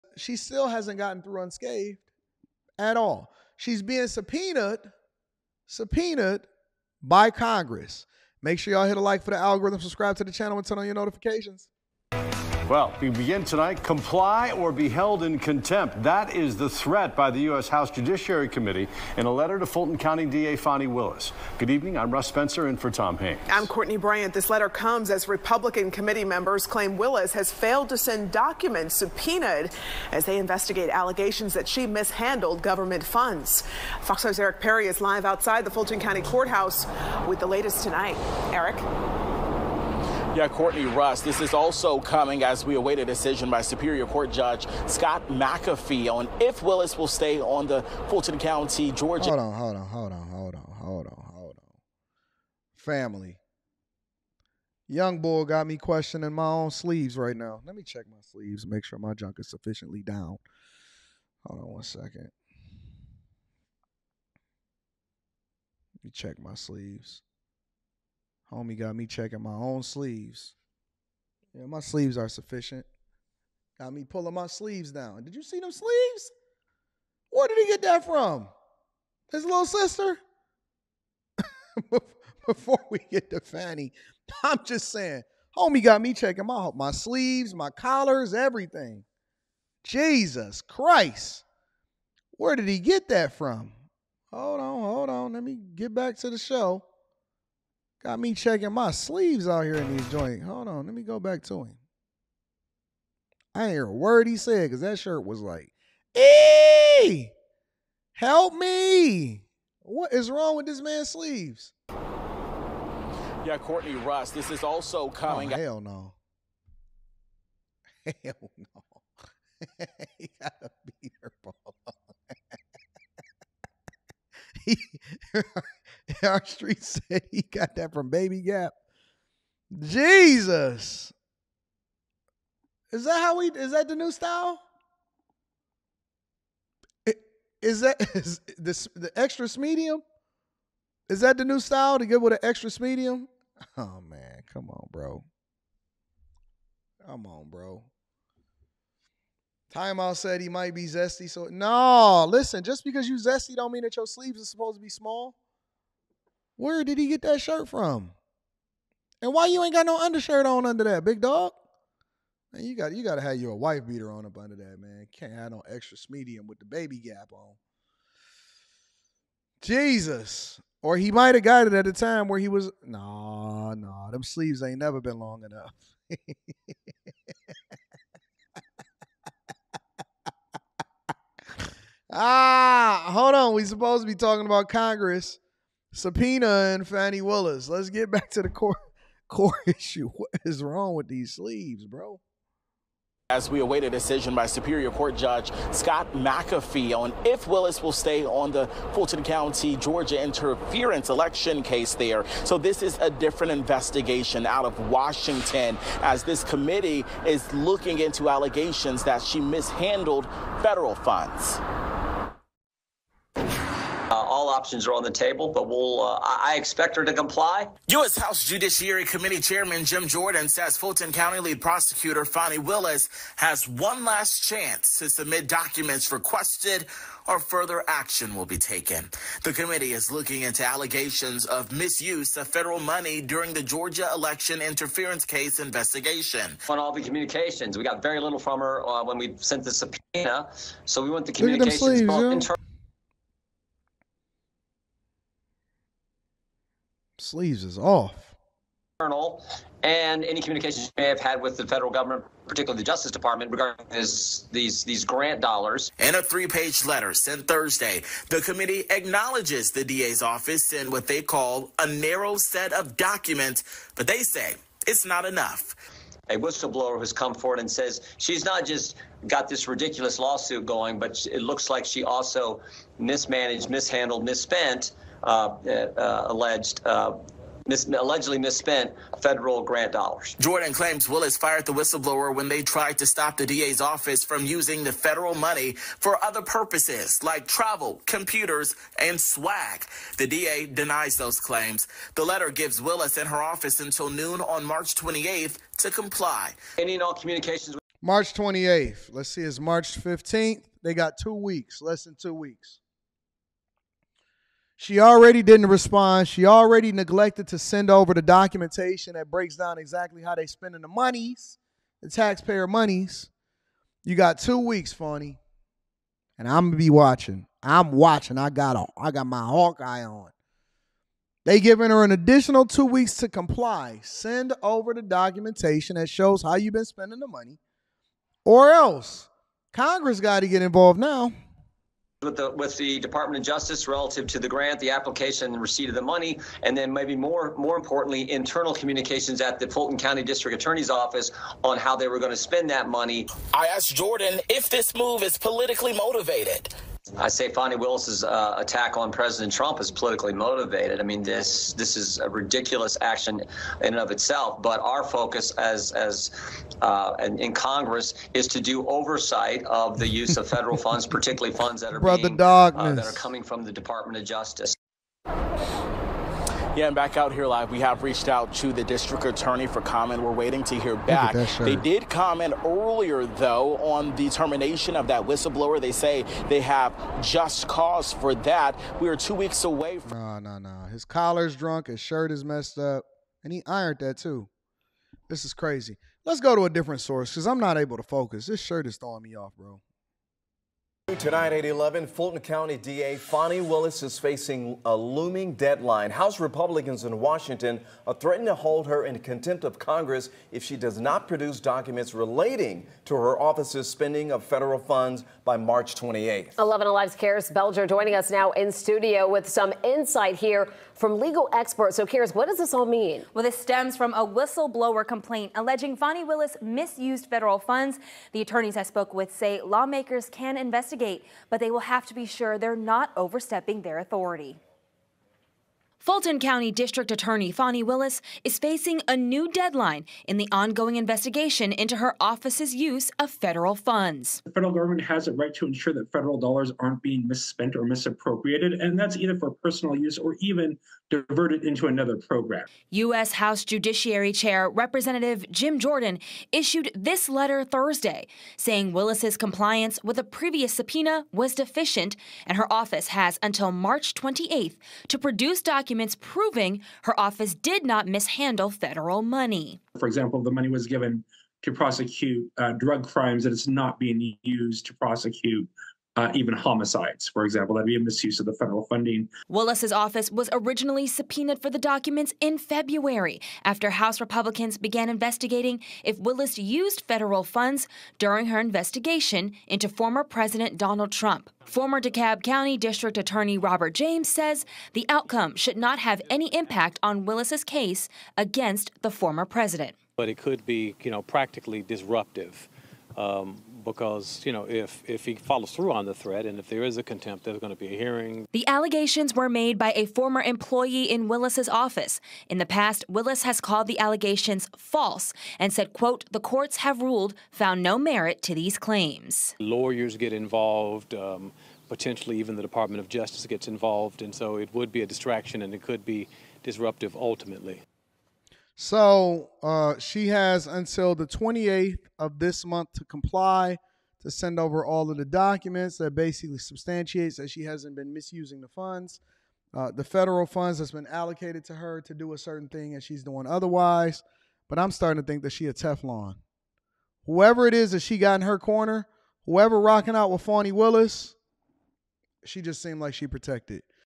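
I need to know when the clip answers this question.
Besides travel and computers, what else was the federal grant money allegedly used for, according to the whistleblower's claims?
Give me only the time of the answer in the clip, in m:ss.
4:49.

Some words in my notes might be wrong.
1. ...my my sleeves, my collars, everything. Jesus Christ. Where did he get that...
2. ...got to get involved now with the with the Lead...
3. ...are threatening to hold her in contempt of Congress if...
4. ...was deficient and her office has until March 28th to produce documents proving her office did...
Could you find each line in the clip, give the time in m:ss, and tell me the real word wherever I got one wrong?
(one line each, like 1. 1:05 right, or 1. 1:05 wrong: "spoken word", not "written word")
1. 1:26 right
2. 5:30 wrong: "Department", not "Lead"
3. 6:38 right
4. 7:31 right.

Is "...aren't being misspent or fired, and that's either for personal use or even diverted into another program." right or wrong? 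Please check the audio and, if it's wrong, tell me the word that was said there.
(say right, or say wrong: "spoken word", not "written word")
wrong: "misappropriated", not "fired".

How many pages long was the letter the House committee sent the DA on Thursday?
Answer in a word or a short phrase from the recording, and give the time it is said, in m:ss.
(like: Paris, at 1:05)
3, at 4:16.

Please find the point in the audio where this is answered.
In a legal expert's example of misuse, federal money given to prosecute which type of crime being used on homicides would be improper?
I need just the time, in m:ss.
7:42.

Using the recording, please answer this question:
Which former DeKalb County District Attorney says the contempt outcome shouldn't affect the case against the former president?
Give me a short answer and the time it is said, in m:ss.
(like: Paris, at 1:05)
Robert James, at 8:03.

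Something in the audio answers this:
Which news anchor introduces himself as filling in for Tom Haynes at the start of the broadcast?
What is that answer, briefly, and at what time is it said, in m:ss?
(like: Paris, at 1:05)
Russ Spencer, at 0:22.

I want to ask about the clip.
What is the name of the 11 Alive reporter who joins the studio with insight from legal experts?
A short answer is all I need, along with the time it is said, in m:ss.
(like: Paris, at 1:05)
Karis Belger, at 6:47.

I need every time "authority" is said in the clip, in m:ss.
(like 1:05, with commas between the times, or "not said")
7:03.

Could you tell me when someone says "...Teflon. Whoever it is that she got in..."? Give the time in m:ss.
8:55.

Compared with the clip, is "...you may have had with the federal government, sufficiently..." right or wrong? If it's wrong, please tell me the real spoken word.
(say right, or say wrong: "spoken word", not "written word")
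wrong: "particularly", not "sufficiently".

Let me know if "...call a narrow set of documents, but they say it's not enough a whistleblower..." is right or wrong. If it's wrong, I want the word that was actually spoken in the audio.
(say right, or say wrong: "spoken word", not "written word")
right.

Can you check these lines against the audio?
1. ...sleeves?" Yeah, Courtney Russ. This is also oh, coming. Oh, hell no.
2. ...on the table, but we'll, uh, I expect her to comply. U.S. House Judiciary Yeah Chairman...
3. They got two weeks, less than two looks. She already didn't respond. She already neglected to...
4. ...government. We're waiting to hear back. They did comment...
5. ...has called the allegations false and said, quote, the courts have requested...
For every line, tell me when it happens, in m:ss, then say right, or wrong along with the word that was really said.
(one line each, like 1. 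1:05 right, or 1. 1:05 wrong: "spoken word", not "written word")
1. 1:51 right
2. 3:34 wrong: "Committee", not "Yeah"
3. 5:00 wrong: "weeks", not "looks"
4. 6:09 wrong: "comment", not "government"
5. 8:23 wrong: "ruled", not "requested".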